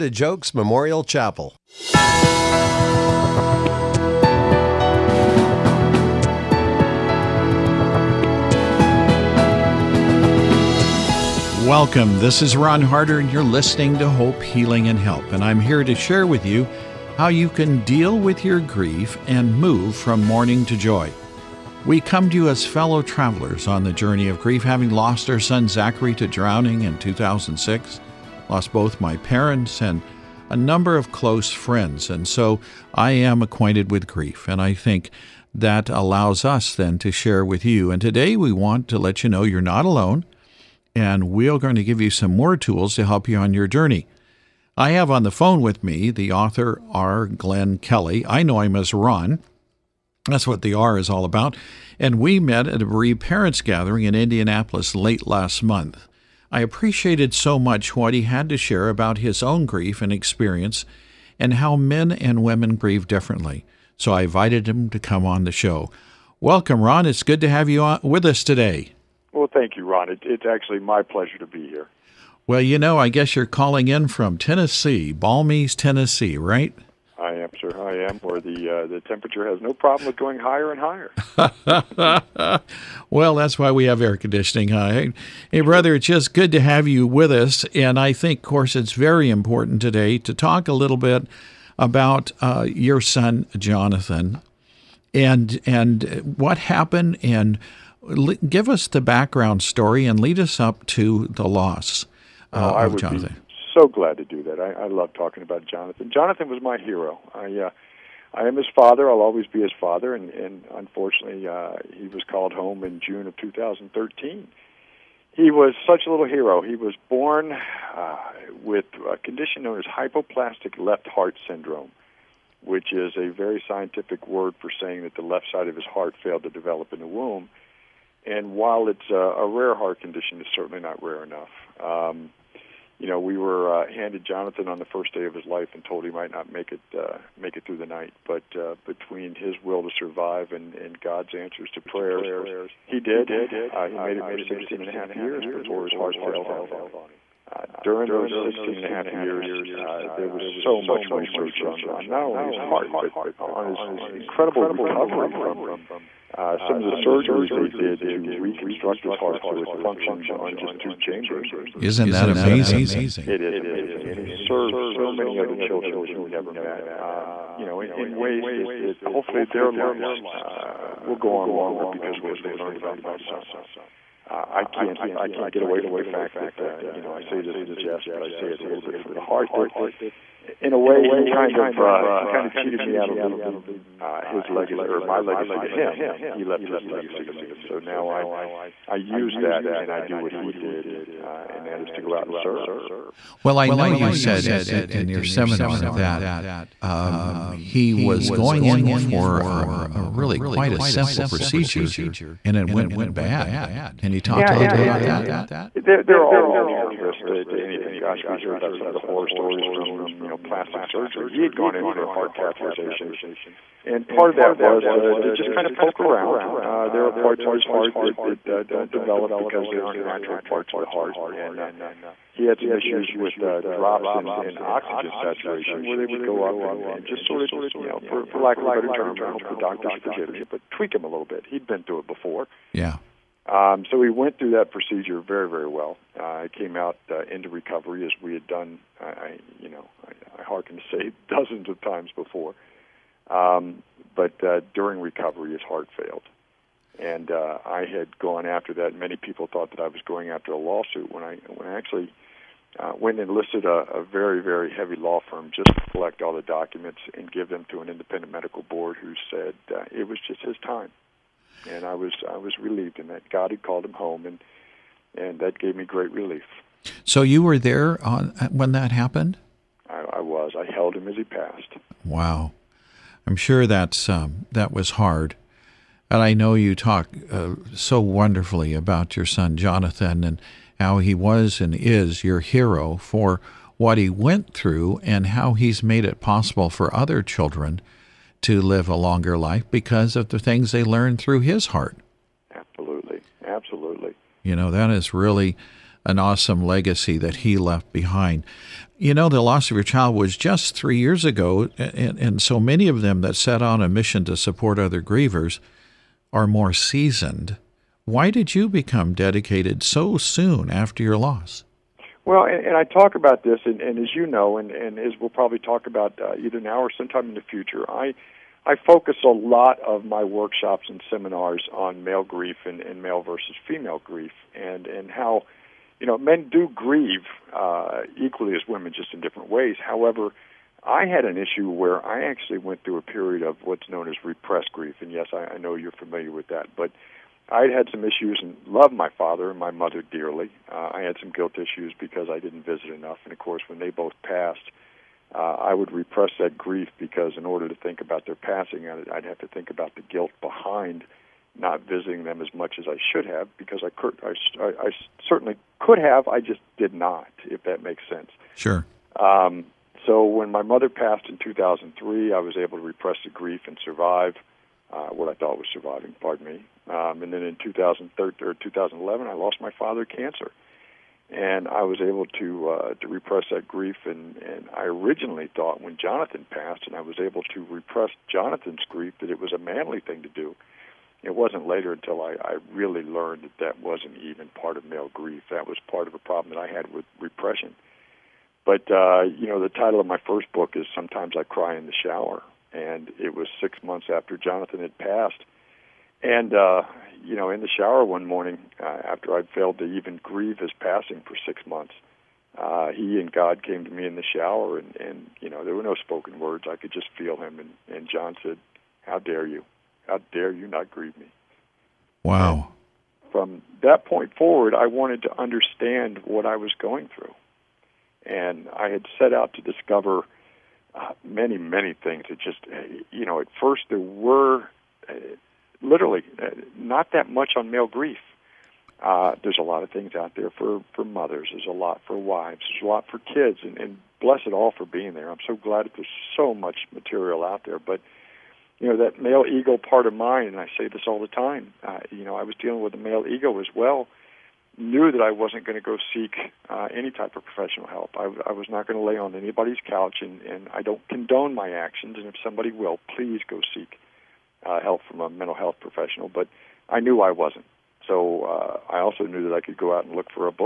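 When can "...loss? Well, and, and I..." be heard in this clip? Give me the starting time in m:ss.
5:11.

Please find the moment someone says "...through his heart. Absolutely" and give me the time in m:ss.
4:51.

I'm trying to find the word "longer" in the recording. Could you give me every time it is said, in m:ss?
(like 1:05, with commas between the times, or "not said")
2:51, 4:48.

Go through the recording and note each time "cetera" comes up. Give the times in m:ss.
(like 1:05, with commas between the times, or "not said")
not said.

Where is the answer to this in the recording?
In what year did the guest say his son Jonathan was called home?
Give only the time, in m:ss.
1:53.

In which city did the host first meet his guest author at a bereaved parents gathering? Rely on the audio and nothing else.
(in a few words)
Indianapolis.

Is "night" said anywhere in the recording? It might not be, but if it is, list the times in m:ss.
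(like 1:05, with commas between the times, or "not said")
2:17.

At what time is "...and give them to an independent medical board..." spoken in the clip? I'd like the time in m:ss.
4:17.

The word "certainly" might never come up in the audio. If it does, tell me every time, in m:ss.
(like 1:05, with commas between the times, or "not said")
2:10, 5:55.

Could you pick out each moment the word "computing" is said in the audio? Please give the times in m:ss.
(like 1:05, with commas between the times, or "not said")
not said.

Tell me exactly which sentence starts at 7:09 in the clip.
Uh, there's a lot of things out there for, for mothers.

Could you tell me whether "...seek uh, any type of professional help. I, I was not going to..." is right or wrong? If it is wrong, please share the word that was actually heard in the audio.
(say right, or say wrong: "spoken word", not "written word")
right.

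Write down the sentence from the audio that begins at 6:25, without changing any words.
That was part of a problem that I had with repression.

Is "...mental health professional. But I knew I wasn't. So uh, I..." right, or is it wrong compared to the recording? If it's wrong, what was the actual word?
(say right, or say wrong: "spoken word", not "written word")
right.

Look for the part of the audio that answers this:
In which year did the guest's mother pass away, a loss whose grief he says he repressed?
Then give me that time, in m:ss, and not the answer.
6:01.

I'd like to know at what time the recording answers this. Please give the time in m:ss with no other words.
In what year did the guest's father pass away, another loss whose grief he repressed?
6:08.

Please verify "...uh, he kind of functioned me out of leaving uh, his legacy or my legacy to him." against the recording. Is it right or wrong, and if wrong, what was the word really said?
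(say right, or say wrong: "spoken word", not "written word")
wrong: "cheated", not "functioned".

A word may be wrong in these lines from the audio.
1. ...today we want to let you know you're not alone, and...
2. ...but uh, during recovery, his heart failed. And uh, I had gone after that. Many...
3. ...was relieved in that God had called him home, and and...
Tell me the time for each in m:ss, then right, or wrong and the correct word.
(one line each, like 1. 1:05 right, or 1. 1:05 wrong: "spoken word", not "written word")
1. 0:37 right
2. 4:04 right
3. 4:22 right.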